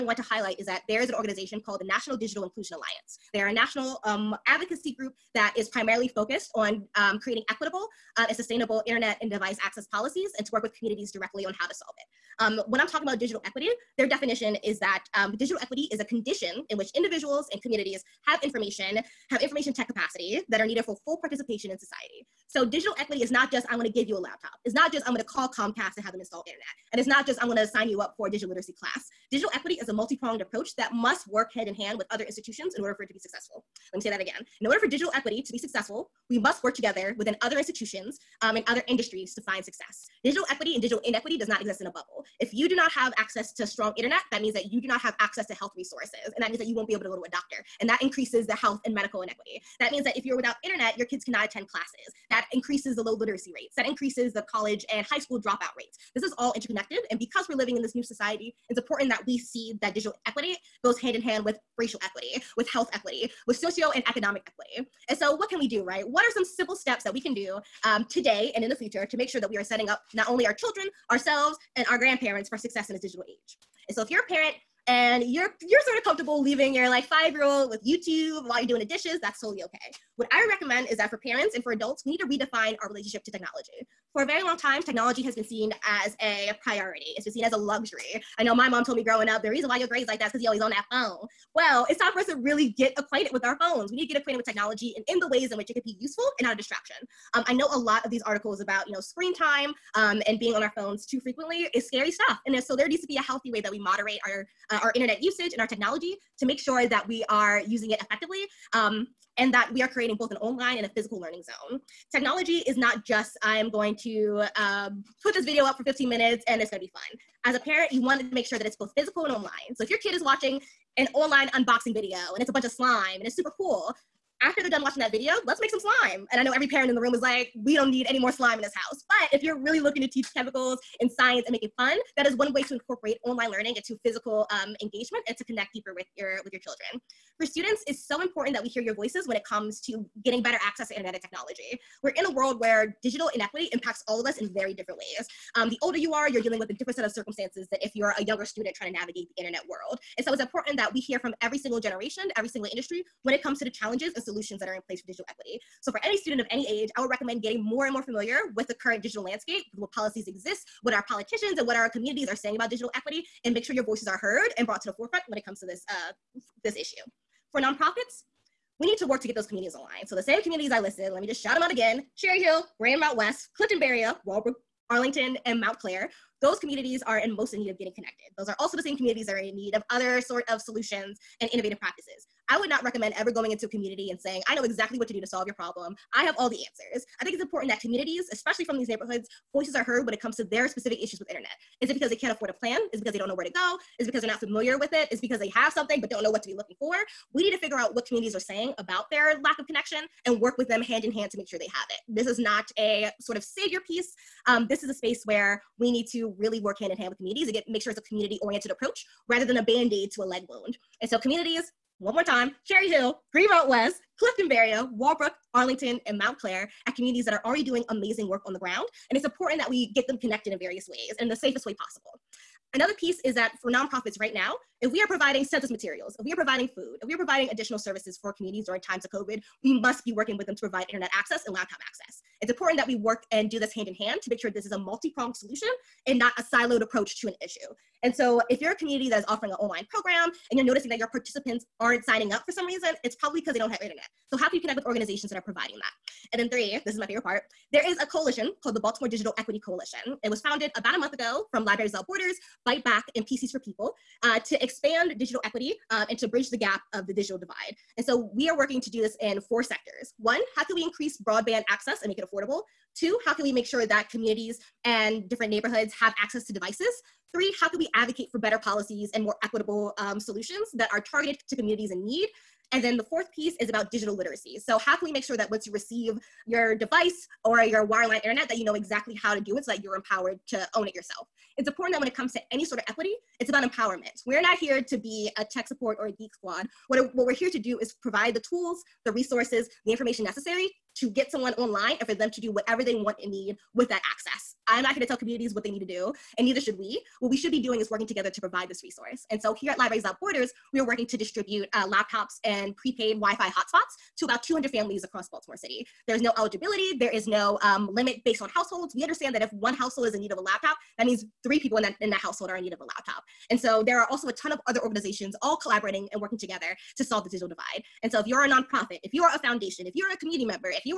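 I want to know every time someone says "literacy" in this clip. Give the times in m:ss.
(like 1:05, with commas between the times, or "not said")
0:28, 0:53, 4:34.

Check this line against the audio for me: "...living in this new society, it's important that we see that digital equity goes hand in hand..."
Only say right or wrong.
right.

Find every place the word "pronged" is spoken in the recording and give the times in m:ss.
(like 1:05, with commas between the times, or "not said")
0:29, 3:55.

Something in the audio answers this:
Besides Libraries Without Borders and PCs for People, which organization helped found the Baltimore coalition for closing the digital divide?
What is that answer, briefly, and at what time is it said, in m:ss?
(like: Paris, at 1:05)
Byte Back, at 4:12.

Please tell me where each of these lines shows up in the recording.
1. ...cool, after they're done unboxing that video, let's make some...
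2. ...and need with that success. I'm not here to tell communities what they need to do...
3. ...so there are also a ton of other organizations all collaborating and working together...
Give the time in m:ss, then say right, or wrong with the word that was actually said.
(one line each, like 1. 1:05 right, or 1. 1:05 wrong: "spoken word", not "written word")
1. 2:03 wrong: "watching", not "unboxing"
2. 4:53 wrong: "access", not "success"
3. 5:13 right.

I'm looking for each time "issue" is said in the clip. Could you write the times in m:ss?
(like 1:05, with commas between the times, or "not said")
2:46, 3:11, 3:57.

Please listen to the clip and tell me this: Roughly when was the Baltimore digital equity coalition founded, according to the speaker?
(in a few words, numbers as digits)
About a month ago.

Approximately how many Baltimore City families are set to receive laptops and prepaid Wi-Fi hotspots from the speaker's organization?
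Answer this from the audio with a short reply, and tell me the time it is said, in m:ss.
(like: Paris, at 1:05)
200, at 5:04.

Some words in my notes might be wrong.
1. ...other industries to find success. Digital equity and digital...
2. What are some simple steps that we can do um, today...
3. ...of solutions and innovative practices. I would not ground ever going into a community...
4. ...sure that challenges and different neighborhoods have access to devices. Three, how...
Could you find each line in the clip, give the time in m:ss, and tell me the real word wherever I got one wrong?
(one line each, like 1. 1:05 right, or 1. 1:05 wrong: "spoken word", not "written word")
1. 0:38 right
2. 1:06 right
3. 3:00 wrong: "recommend", not "ground"
4. 4:23 wrong: "communities", not "challenges".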